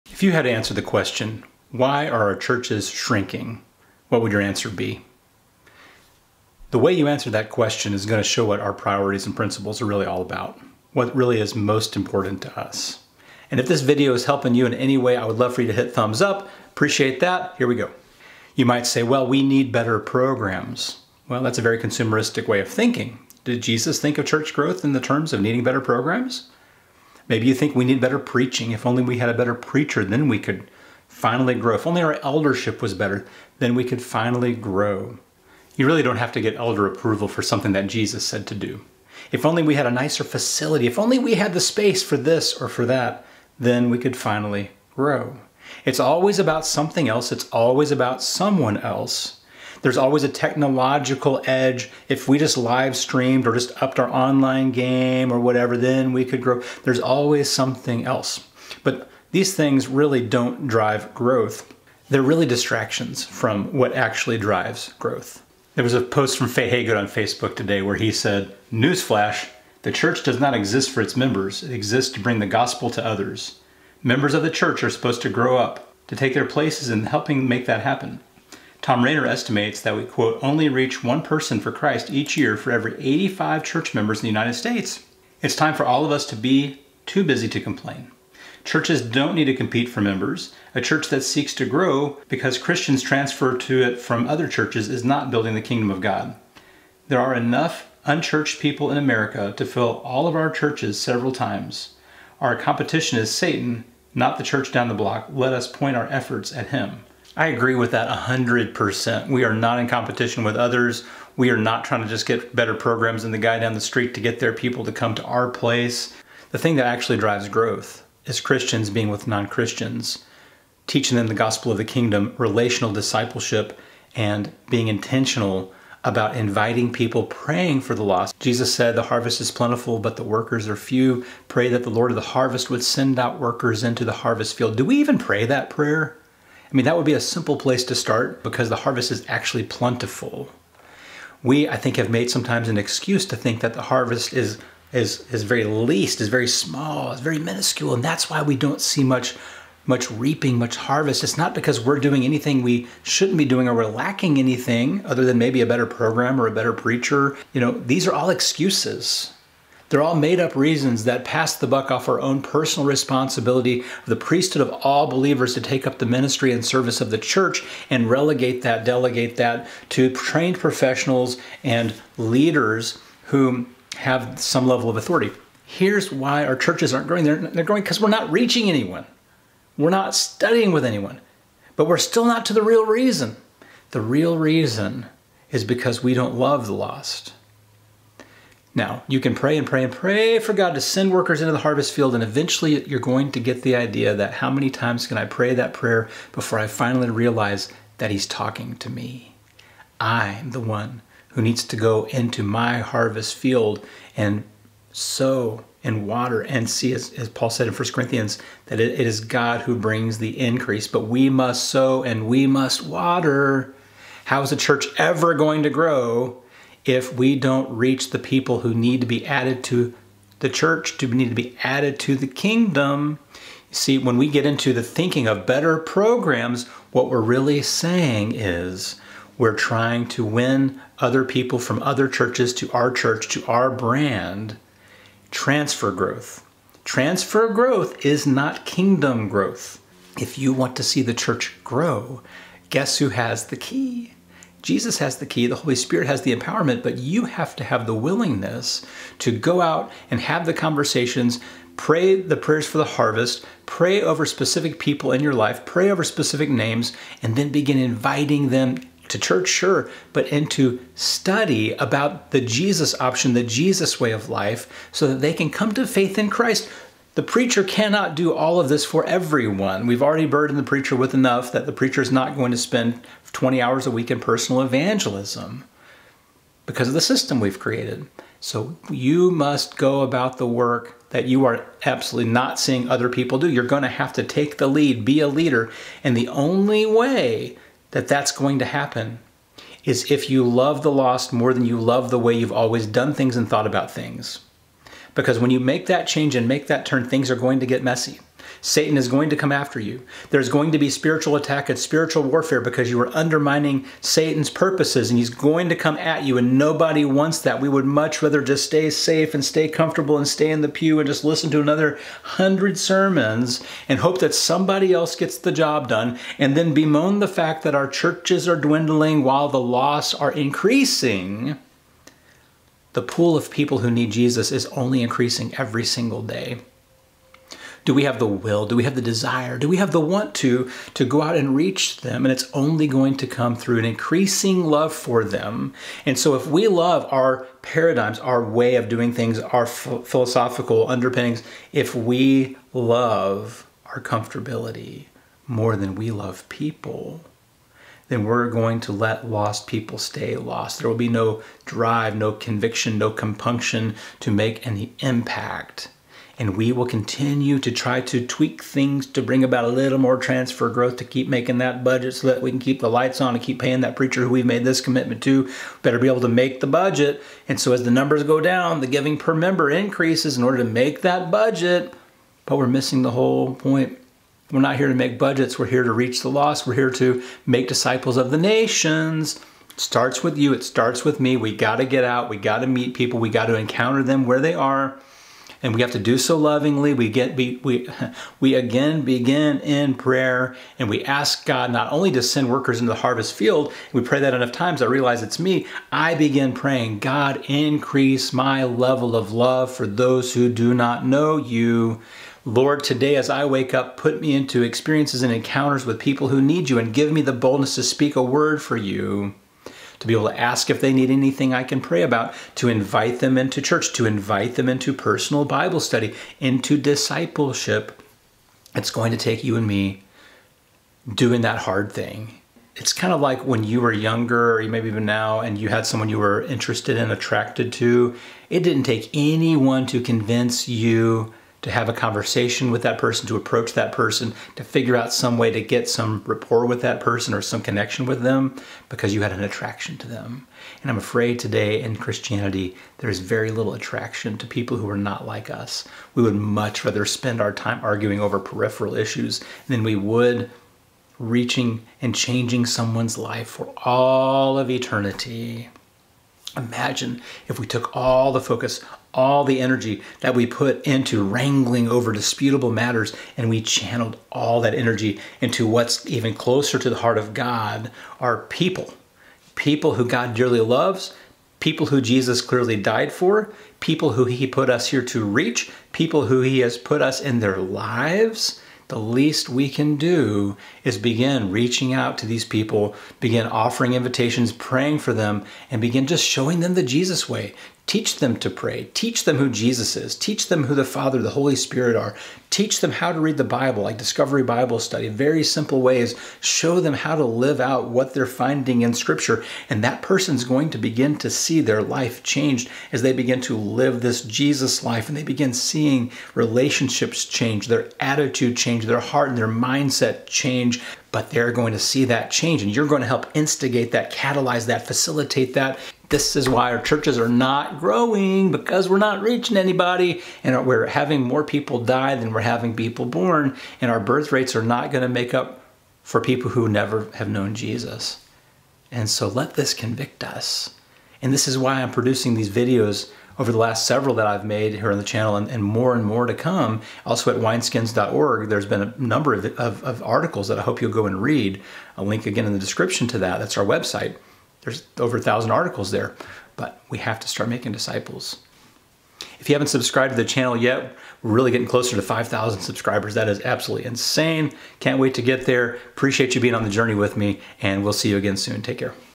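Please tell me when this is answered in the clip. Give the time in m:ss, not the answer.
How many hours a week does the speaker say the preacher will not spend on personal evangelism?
4:33.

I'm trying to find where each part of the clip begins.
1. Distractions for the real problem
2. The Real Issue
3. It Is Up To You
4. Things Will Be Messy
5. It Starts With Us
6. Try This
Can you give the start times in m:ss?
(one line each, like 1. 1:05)
1. 0:18
2. 1:56
3. 3:43
4. 4:54
5. 6:19
6. 8:01.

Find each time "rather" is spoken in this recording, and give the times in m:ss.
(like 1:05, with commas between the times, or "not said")
5:08, 7:26.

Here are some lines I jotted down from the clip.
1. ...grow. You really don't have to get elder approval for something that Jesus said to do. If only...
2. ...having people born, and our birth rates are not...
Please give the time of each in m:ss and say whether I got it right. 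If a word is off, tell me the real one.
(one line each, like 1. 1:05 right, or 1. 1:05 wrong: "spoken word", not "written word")
1. 0:34 right
2. 8:42 right.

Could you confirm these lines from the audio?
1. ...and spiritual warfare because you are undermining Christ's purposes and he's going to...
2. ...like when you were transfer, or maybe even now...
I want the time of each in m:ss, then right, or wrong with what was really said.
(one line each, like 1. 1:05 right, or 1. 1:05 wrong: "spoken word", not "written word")
1. 5:01 wrong: "Satan", not "Christ"
2. 7:03 wrong: "younger", not "transfer".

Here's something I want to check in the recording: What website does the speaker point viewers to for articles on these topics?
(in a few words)
wineskins.org.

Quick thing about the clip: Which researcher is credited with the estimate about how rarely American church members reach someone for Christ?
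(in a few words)
Tom Rainer.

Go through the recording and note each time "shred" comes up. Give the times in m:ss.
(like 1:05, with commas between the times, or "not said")
not said.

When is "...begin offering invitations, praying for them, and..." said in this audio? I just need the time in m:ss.
8:03.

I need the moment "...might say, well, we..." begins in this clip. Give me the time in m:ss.
0:18.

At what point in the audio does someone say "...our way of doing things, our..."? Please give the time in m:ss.
5:38.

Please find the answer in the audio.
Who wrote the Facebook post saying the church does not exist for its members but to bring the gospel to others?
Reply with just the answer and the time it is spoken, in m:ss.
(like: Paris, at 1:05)
Faye Haygood, at 1:06.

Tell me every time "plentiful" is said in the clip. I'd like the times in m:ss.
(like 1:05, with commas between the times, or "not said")
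2:09, 2:19.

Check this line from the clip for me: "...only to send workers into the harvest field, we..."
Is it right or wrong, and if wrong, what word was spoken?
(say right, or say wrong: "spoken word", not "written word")
right.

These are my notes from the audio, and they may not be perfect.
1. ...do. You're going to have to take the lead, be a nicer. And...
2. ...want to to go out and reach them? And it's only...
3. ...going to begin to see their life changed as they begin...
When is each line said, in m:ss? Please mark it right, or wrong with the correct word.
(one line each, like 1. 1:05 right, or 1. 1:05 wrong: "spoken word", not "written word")
1. 4:43 wrong: "leader", not "nicer"
2. 5:30 right
3. 8:20 right.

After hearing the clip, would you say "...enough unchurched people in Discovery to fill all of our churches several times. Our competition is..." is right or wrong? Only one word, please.
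wrong.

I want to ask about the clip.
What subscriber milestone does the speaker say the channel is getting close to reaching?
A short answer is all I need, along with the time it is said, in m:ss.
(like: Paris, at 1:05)
5,000, at 9:12.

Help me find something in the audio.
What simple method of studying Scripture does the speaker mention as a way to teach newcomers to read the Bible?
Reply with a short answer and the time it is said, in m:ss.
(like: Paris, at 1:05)
Discovery Bible Study, at 8:13.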